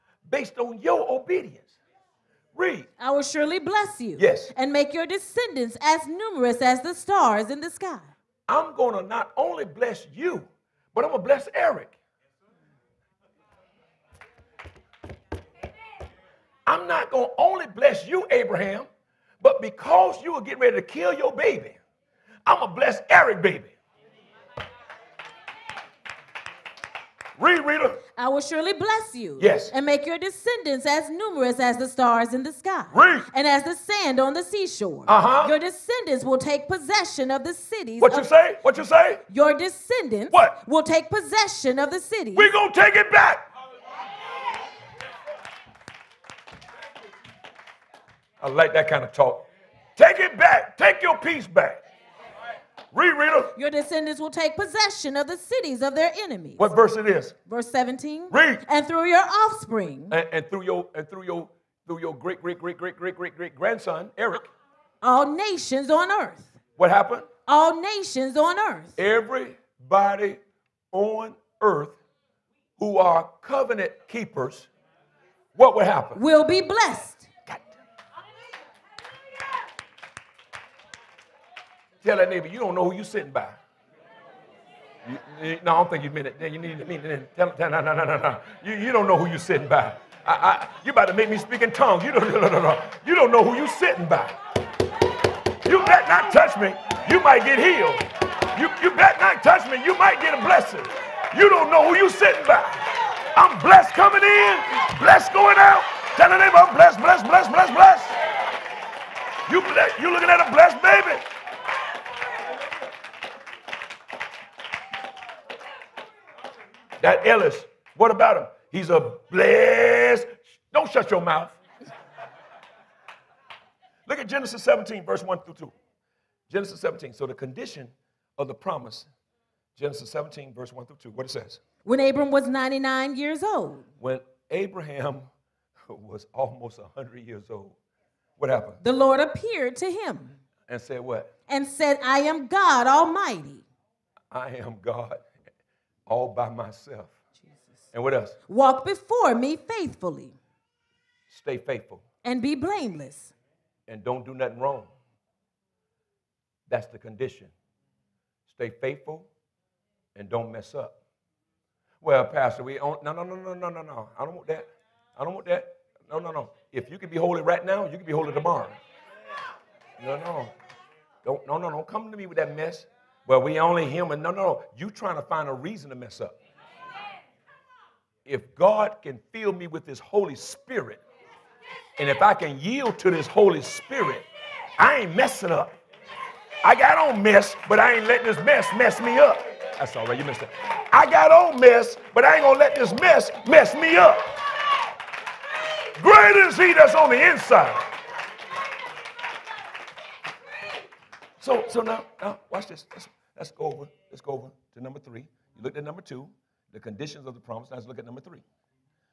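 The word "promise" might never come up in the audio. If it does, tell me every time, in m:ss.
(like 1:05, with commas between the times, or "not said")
2:08, 3:27.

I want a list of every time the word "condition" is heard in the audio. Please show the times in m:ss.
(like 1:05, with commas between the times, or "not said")
2:07, 2:36, 3:26.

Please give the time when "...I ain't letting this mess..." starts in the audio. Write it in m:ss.
3:07.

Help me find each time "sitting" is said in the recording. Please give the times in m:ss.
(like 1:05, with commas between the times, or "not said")
1:23, 1:29, 1:33, 1:42.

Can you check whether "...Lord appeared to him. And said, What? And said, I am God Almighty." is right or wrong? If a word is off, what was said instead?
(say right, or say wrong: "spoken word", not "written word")
right.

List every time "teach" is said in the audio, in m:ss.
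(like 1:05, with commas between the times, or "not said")
not said.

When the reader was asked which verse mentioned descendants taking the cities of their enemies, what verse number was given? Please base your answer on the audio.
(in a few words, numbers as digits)
Verse 17.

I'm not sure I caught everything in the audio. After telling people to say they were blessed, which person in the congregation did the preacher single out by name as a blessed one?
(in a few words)
Ellis.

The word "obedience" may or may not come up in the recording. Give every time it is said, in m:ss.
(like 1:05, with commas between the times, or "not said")
0:01.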